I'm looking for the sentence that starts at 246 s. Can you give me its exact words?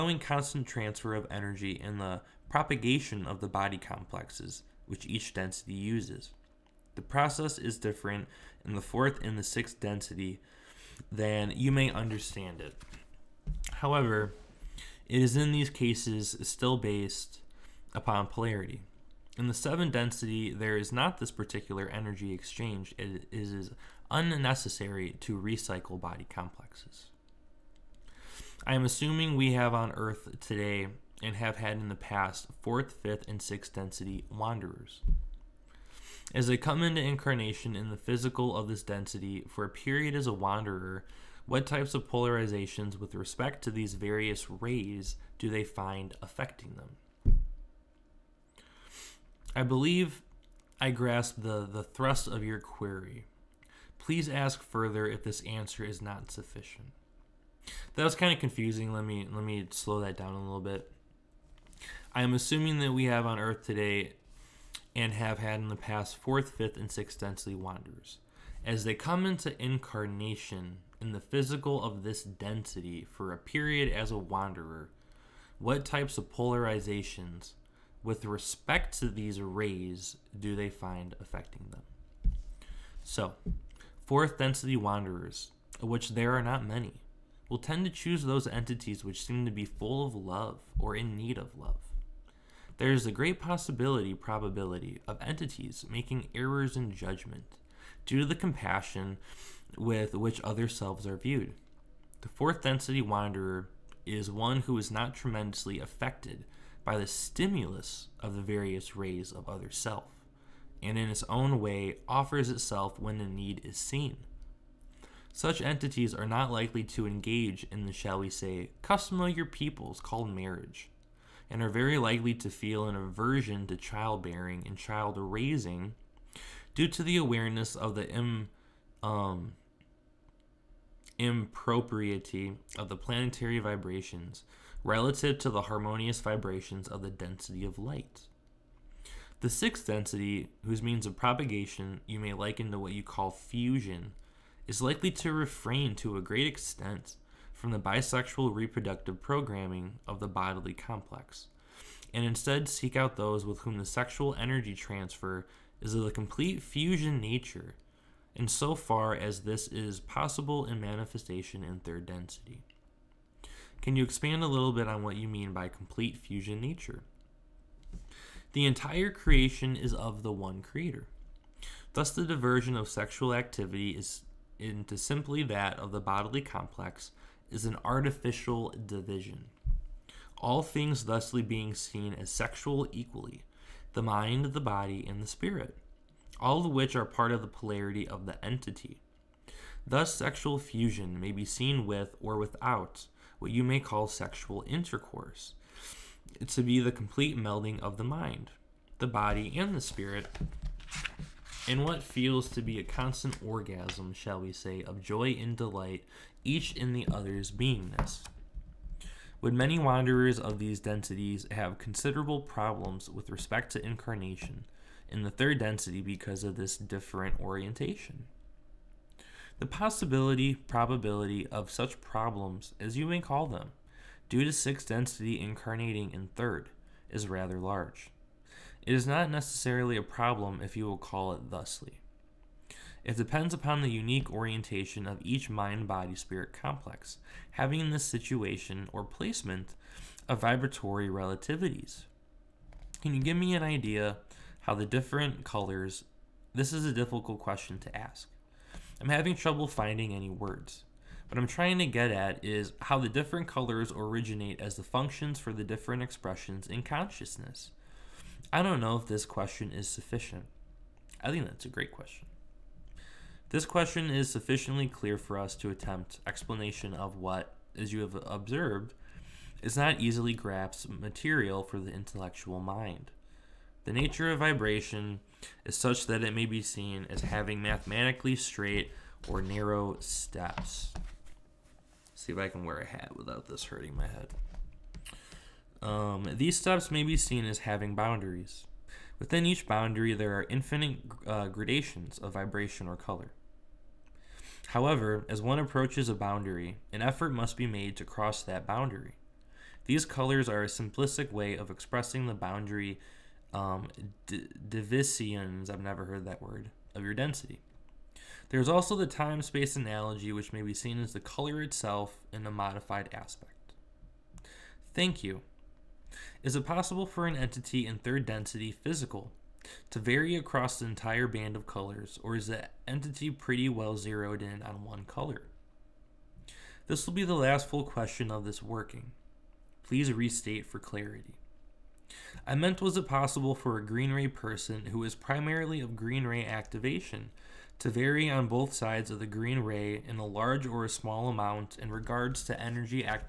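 This is a difficult question to ask.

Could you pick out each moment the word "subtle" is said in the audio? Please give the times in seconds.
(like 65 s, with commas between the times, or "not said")
not said.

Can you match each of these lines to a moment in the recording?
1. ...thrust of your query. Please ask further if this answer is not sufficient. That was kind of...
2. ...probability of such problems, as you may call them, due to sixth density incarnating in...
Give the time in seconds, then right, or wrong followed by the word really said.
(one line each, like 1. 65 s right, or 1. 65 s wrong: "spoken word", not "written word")
1. 51 s right
2. 220 s right.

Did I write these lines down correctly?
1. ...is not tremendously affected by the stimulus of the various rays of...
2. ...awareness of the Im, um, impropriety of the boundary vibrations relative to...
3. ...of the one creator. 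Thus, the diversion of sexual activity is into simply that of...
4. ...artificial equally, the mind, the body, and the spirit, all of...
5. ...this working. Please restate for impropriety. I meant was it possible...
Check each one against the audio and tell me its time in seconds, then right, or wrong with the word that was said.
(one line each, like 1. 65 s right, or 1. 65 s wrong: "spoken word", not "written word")
1. 104 s right
2. 127 s wrong: "planetary", not "boundary"
3. 169 s right
4. 182 s wrong: "sexual", not "artificial"
5. 328 s wrong: "clarity", not "impropriety".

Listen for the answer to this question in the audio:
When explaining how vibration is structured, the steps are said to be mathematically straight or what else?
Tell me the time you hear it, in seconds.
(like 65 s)
279 s.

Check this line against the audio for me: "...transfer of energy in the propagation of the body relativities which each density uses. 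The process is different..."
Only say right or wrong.
wrong.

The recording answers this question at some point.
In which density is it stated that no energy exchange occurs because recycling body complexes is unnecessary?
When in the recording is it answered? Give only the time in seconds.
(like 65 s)
19 s.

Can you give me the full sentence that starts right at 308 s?
There's also the time space analogy, which may be seen as the color itself in a modified aspect.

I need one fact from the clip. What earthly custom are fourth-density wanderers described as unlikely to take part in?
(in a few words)
marriage.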